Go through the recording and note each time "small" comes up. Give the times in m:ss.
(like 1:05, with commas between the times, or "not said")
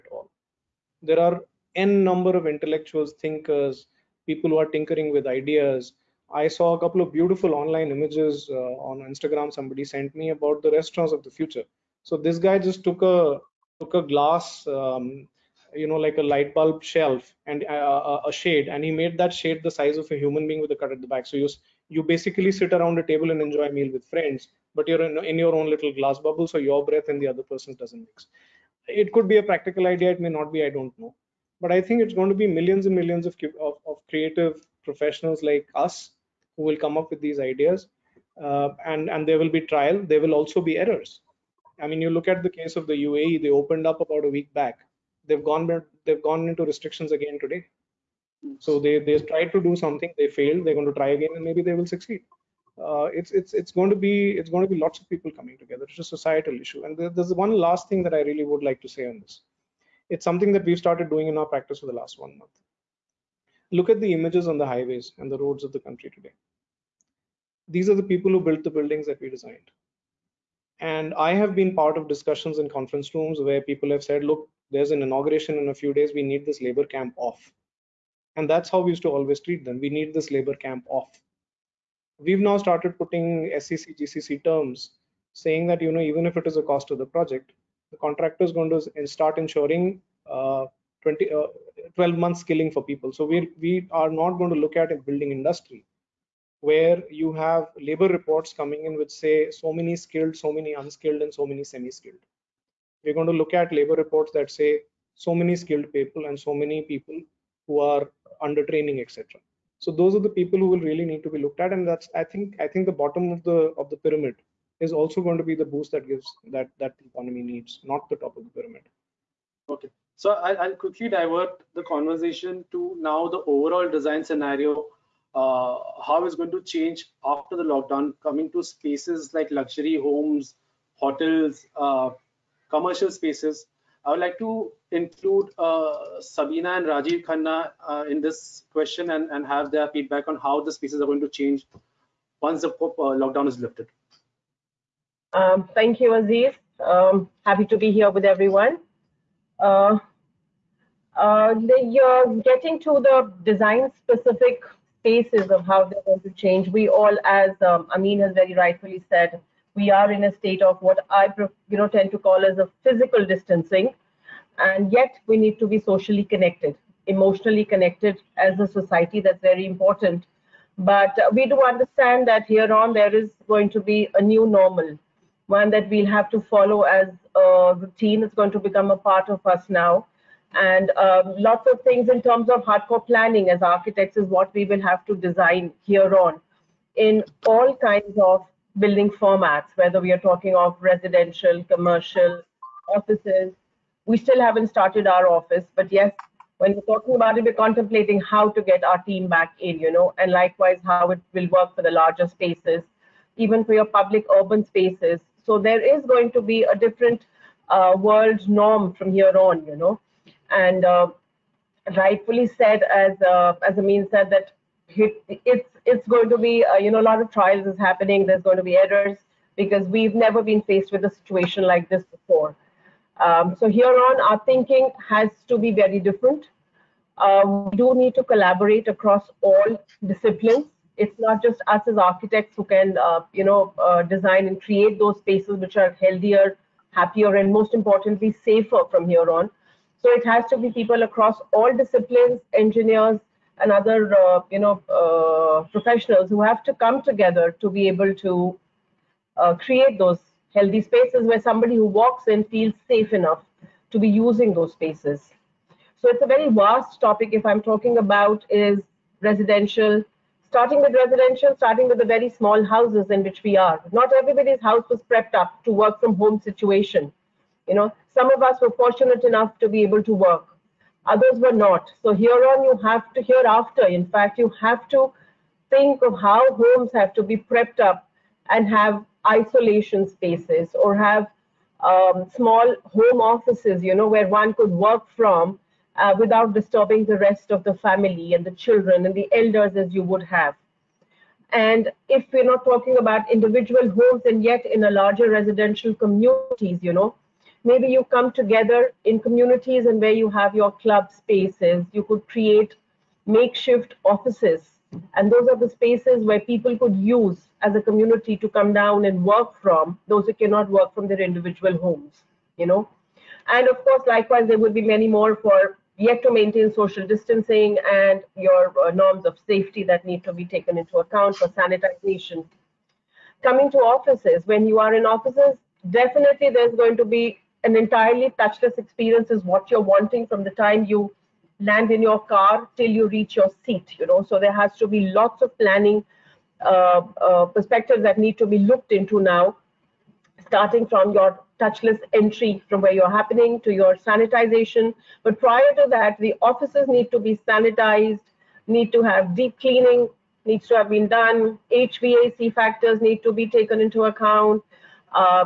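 4:22, 4:42.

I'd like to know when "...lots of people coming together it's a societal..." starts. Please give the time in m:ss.
0:54.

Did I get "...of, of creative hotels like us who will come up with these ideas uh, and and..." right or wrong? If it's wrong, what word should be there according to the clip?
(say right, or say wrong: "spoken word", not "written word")
wrong: "professionals", not "hotels".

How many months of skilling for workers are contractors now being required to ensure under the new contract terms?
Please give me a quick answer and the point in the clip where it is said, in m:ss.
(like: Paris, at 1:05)
12, at 1:31.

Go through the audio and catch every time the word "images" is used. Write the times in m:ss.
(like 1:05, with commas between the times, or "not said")
0:07, 1:04.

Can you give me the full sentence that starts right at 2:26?
Um, happy to be here with everyone.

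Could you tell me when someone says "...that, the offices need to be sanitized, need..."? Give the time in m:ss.
5:45.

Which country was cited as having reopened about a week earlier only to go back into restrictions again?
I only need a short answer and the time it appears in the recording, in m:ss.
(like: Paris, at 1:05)
UAE, at 0:43.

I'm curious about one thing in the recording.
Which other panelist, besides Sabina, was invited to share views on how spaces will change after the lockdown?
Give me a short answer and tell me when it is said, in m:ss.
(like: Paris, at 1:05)
Rajiv Khanna, at 2:16.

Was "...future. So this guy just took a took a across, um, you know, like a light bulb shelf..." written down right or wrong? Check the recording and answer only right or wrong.
wrong.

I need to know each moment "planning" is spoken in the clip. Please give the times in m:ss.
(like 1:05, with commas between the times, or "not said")
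3:03, 5:35.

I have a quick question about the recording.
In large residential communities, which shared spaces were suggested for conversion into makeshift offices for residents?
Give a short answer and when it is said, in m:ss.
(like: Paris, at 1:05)
Club spaces, at 5:00.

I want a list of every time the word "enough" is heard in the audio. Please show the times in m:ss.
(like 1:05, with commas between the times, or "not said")
4:13, 4:29.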